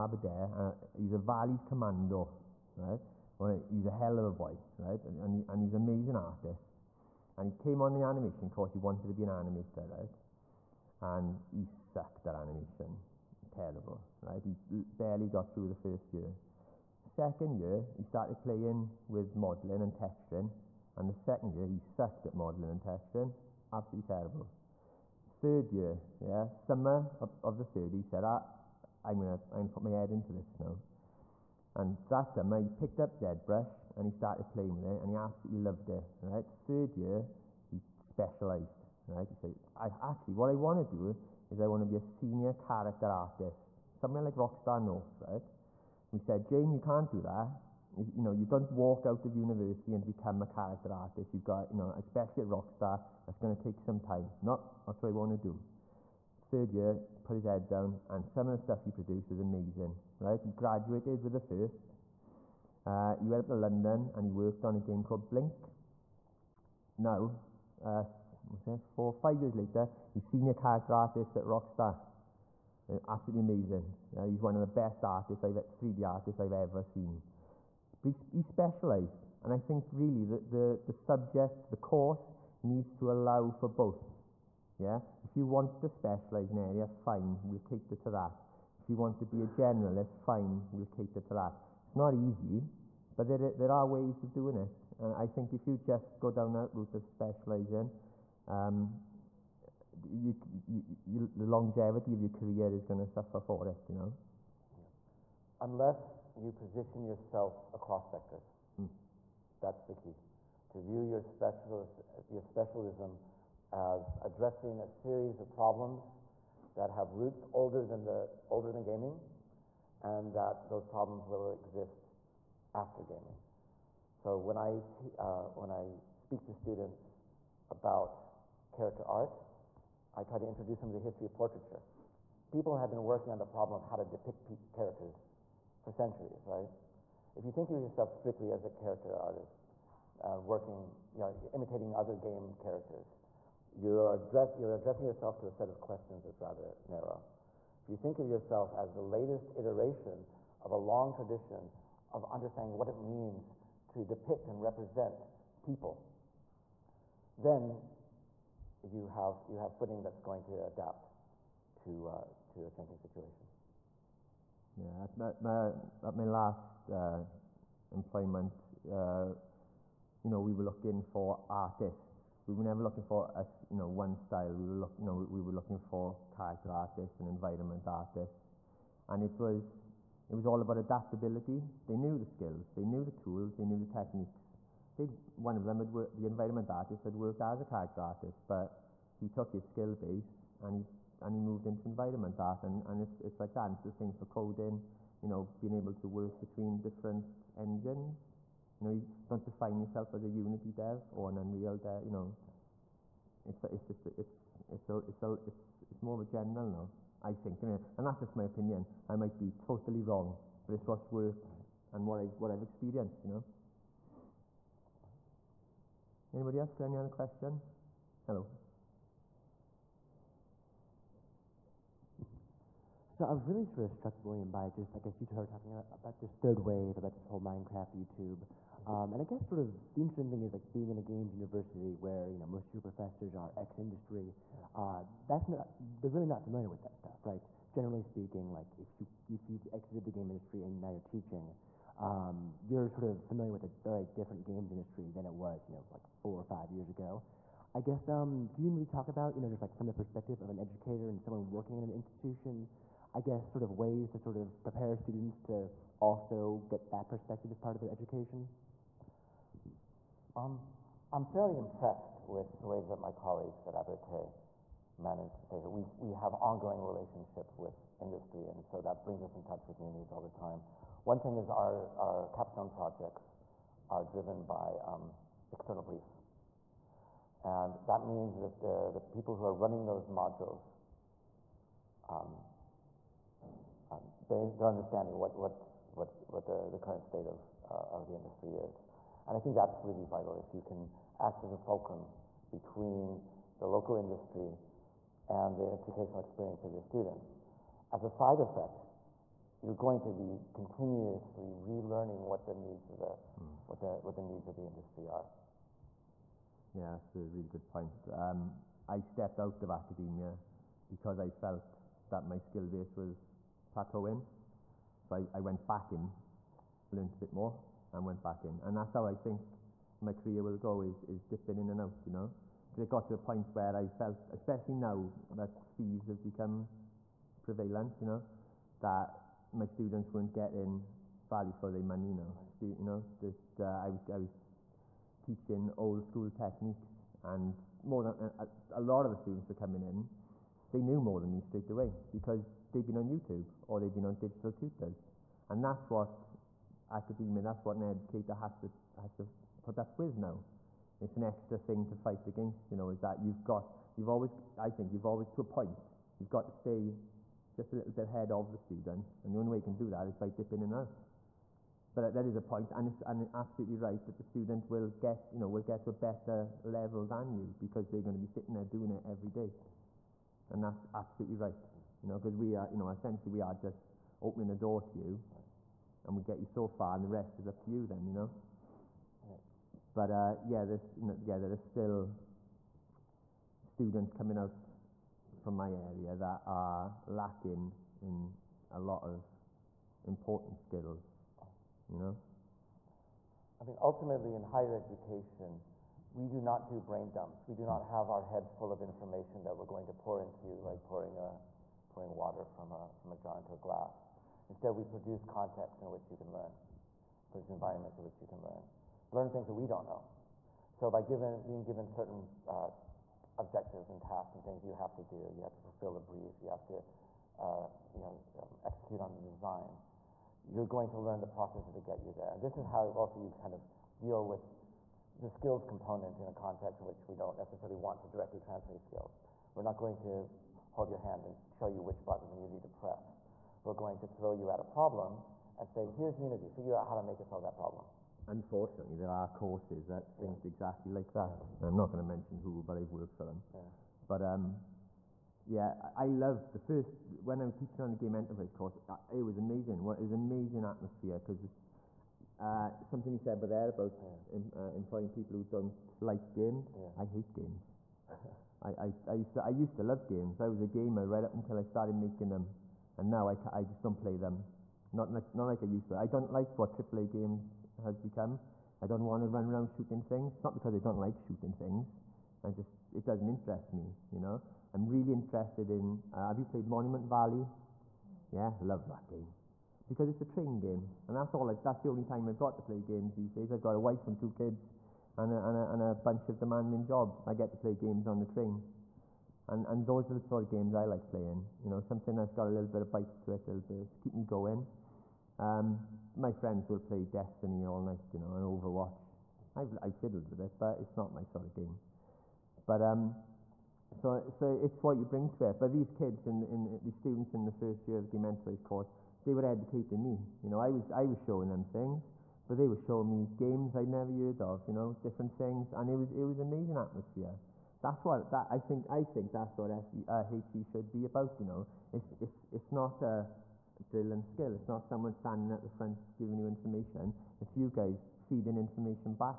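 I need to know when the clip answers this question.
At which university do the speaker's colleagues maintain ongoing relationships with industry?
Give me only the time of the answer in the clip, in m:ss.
4:23.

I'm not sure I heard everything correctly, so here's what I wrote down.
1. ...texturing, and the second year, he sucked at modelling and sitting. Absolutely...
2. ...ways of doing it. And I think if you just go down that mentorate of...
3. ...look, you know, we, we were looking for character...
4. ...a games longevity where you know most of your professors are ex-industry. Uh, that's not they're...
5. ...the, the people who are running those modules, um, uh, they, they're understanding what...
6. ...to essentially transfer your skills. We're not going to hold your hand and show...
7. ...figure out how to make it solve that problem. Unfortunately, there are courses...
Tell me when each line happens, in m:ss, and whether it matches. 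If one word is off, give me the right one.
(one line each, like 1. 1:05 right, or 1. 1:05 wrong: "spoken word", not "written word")
1. 0:19 wrong: "texturing", not "sitting"
2. 1:33 wrong: "route", not "mentorate"
3. 2:54 right
4. 3:50 wrong: "university", not "longevity"
5. 4:38 right
6. 7:08 wrong: "directly", not "essentially"
7. 7:16 right.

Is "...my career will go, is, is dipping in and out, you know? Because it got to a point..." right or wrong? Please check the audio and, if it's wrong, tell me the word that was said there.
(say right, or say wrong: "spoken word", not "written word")
right.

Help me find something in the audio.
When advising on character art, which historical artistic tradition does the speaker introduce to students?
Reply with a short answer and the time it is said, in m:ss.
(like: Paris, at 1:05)
Portraiture, at 2:11.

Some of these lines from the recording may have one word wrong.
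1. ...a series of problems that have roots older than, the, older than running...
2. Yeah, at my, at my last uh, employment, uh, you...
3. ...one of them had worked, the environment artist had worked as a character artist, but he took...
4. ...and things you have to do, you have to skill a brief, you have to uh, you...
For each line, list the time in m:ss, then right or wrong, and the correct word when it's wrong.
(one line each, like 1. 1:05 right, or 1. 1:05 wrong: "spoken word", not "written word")
1. 1:54 wrong: "gaming", not "running"
2. 2:44 right
3. 3:05 right
4. 6:54 wrong: "fulfill", not "skill".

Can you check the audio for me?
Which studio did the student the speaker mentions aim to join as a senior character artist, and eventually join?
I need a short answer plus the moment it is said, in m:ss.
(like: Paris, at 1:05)
Rockstar North, at 0:44.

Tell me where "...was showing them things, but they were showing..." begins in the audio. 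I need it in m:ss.
8:31.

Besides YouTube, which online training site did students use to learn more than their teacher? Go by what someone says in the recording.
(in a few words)
Digital-Tutors.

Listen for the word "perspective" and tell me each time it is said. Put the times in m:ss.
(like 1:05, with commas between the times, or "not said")
4:09, 4:17.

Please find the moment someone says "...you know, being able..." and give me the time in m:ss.
3:15.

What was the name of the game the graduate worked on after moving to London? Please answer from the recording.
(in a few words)
Brink.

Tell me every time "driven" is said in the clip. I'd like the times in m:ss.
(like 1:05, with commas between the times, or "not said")
4:34.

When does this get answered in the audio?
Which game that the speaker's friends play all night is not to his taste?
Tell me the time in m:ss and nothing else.
8:17.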